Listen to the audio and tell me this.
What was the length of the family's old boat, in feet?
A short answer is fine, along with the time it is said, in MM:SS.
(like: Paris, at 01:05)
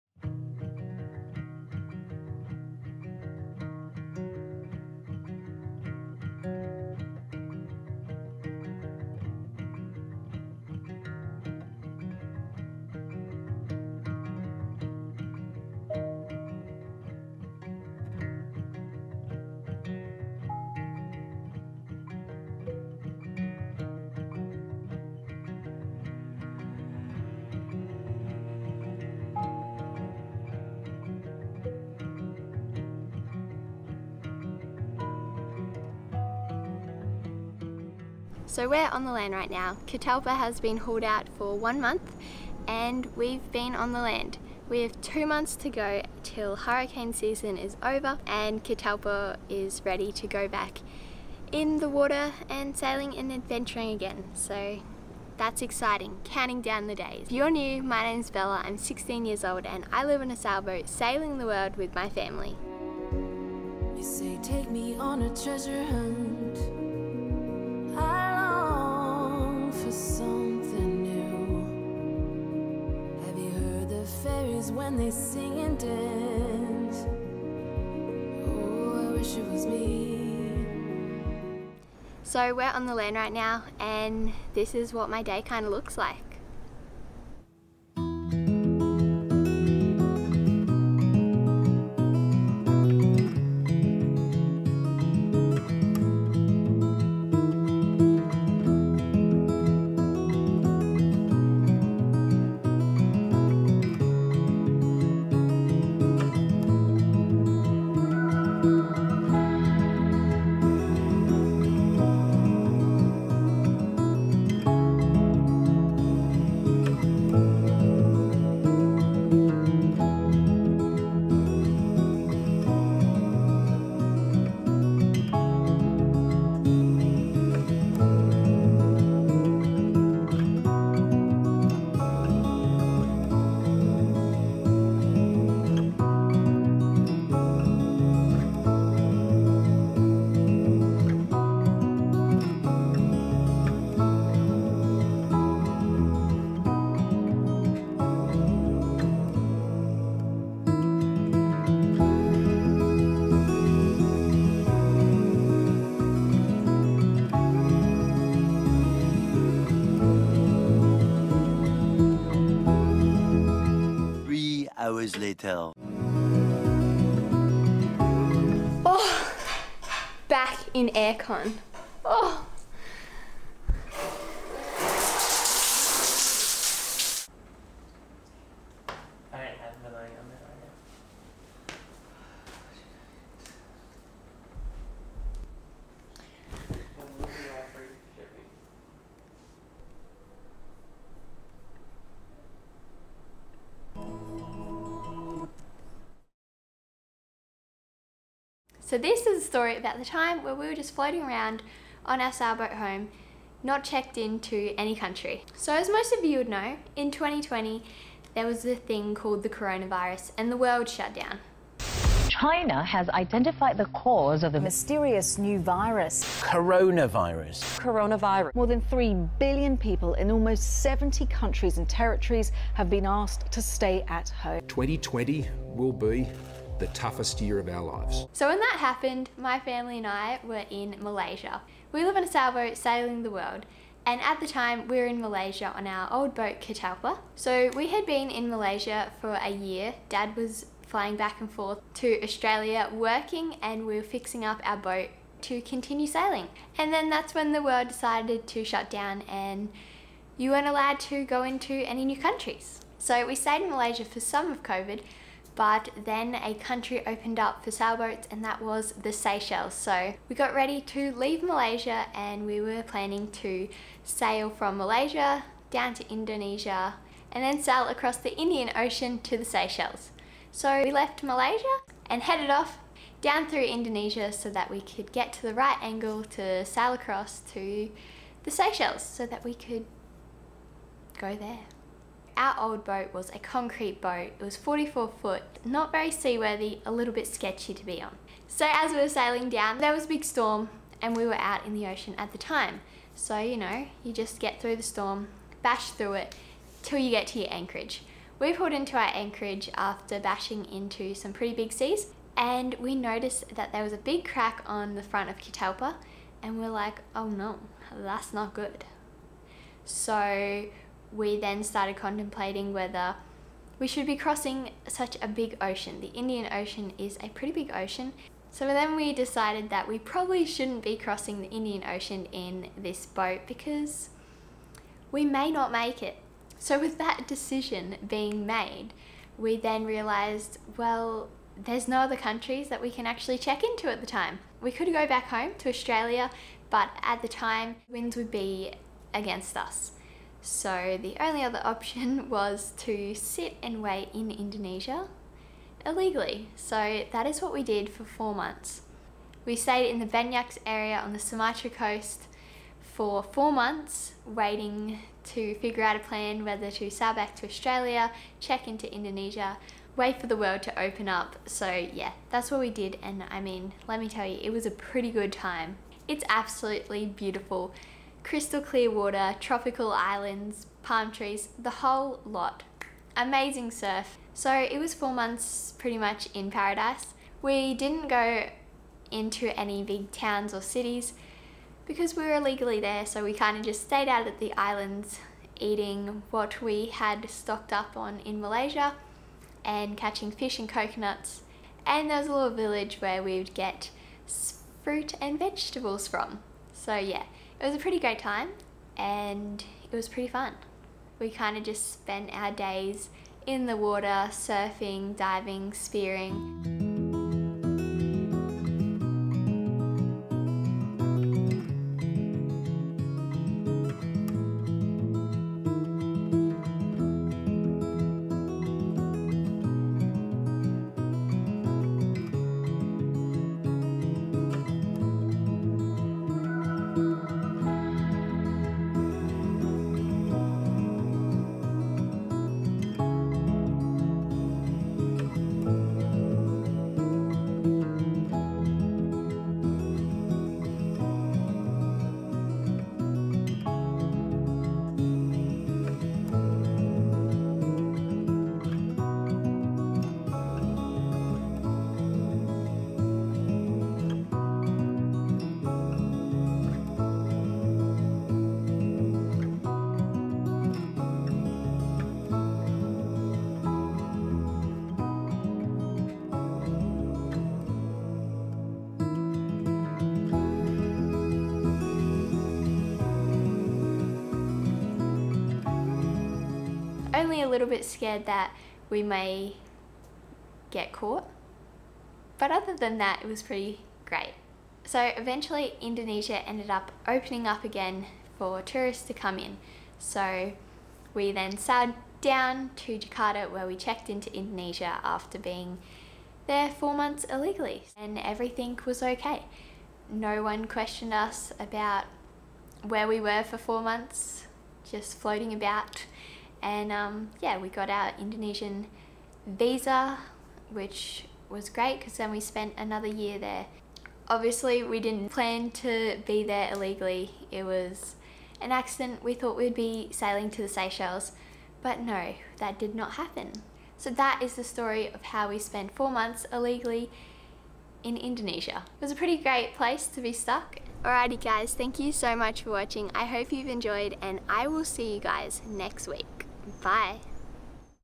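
44 feet, at 04:44.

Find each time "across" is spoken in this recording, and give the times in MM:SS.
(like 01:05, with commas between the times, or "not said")
04:27, 04:36.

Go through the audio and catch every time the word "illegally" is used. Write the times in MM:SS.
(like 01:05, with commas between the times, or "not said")
05:45, 06:22, 08:17, 08:36, 08:46.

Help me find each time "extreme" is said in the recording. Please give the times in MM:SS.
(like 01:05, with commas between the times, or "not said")
not said.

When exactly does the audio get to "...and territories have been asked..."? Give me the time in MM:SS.
03:41.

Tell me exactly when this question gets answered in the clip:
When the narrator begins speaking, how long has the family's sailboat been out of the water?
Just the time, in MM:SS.
00:41.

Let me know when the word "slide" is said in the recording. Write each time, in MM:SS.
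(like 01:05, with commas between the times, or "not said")
not said.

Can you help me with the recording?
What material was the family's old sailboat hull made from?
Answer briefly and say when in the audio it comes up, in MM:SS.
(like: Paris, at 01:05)
Concrete, at 04:43.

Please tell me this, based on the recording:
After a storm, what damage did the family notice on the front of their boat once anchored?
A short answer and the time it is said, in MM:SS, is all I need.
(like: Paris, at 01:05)
A big crack, at 05:03.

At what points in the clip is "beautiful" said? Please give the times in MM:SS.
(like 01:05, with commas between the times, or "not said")
06:07.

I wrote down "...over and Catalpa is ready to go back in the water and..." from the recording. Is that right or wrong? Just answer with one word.
right.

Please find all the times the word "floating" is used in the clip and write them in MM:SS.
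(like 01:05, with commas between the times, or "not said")
03:20, 08:25.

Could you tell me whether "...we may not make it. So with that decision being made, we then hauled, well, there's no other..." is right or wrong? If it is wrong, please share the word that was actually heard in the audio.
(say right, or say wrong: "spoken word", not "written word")
wrong: "realized", not "hauled".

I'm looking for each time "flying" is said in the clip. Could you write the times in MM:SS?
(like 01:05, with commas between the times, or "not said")
04:00.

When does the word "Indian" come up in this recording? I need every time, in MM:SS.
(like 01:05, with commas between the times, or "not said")
04:28, 05:16, 05:21.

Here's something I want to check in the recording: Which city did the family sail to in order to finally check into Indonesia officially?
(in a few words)
Jakarta.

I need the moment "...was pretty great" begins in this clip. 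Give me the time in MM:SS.
08:03.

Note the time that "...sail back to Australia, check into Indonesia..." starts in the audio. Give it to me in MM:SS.
05:56.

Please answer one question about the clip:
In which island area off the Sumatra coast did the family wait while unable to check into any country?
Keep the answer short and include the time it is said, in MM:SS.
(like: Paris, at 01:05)
The Banyaks, at 05:50.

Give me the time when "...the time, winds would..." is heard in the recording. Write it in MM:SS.
05:37.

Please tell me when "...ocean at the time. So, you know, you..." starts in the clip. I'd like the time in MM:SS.
04:51.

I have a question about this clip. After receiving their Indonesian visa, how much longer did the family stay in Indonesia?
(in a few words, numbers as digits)
Another year.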